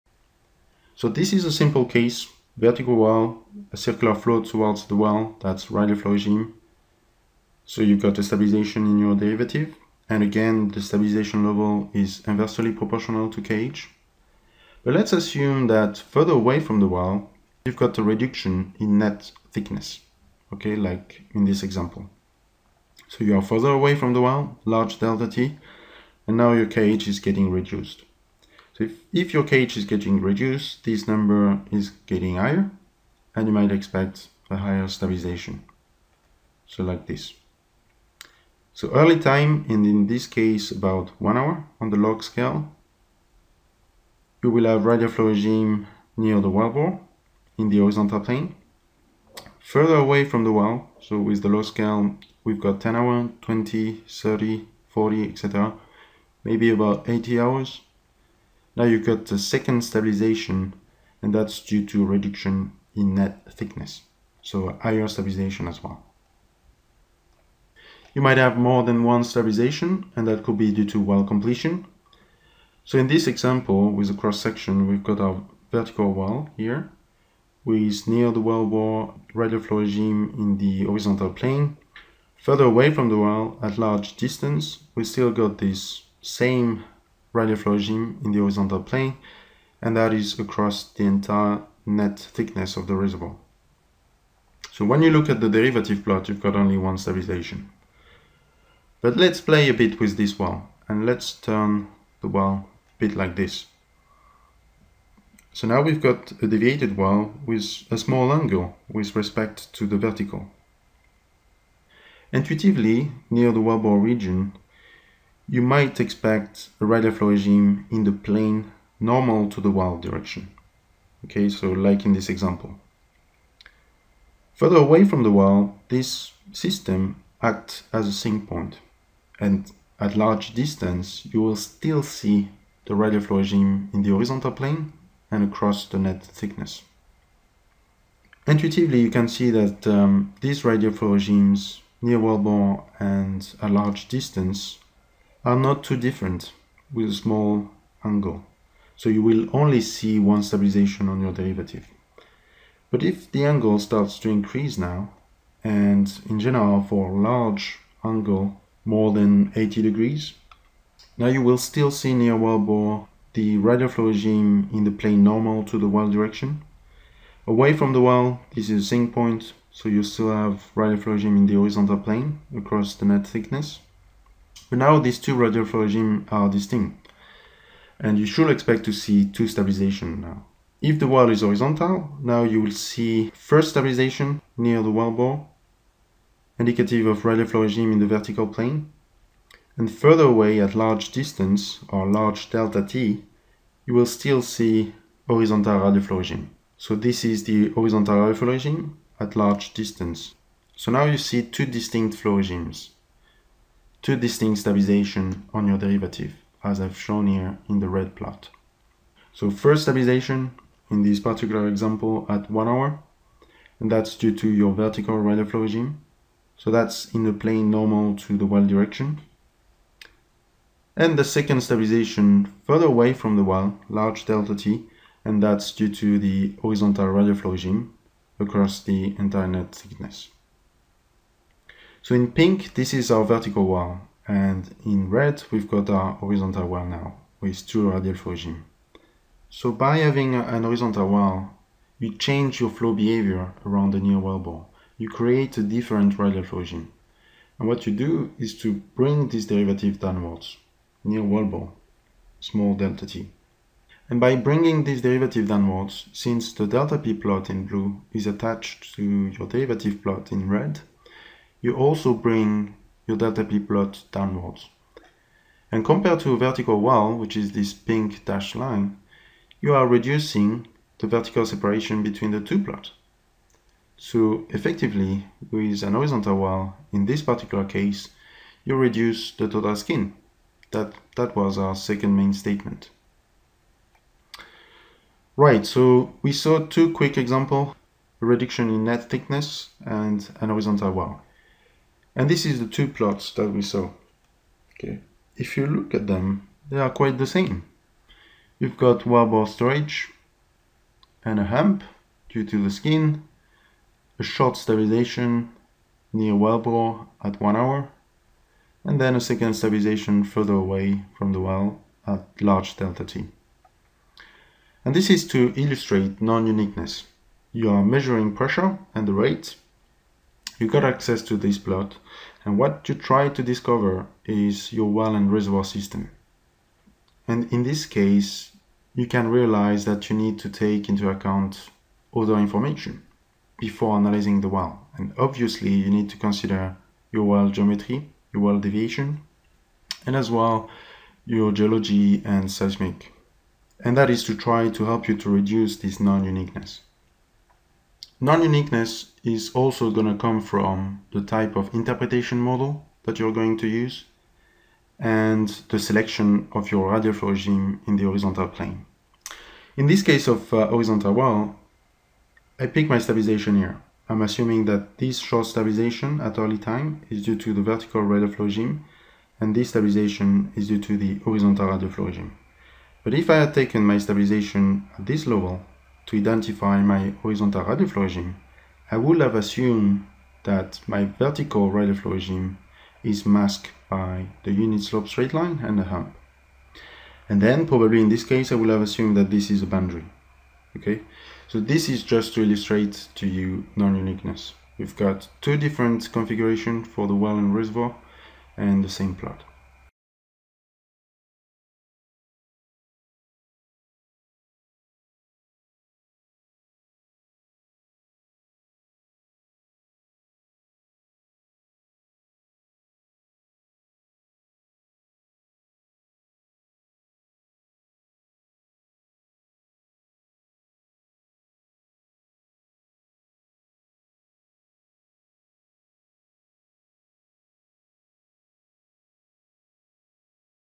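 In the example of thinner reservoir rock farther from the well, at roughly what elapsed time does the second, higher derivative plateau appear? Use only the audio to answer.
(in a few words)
80 hours.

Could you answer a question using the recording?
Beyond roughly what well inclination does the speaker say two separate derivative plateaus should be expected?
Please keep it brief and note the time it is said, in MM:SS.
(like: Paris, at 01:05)
80 degrees, at 02:39.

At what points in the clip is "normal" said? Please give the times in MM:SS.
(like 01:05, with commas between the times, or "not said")
01:59, 02:45, 03:37.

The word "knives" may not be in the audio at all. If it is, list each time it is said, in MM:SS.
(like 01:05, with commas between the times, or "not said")
not said.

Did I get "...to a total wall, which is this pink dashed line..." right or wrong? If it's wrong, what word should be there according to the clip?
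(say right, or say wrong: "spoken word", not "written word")
wrong: "vertical", not "total".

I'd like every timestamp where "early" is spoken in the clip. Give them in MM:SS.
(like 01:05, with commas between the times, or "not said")
00:38, 06:06.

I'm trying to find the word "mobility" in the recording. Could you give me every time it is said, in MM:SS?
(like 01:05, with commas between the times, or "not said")
not said.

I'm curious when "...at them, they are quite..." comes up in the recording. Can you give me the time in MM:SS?
04:55.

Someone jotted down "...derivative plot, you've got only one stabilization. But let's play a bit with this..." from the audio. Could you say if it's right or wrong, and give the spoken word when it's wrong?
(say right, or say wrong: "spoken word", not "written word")
right.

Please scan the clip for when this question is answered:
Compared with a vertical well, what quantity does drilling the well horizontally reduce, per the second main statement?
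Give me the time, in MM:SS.
04:39.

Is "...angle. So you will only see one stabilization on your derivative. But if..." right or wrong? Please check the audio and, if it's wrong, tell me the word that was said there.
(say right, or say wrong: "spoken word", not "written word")
right.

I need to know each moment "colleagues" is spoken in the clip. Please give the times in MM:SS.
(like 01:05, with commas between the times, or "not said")
not said.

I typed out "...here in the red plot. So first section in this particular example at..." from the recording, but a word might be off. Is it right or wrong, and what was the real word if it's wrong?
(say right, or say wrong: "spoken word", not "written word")
wrong: "stabilization", not "section".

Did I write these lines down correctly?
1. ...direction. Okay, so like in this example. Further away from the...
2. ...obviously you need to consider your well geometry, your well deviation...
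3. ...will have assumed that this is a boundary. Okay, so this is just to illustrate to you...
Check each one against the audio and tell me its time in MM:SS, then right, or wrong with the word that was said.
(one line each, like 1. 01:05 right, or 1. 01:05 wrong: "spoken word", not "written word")
1. 02:00 right
2. 05:35 right
3. 06:28 right.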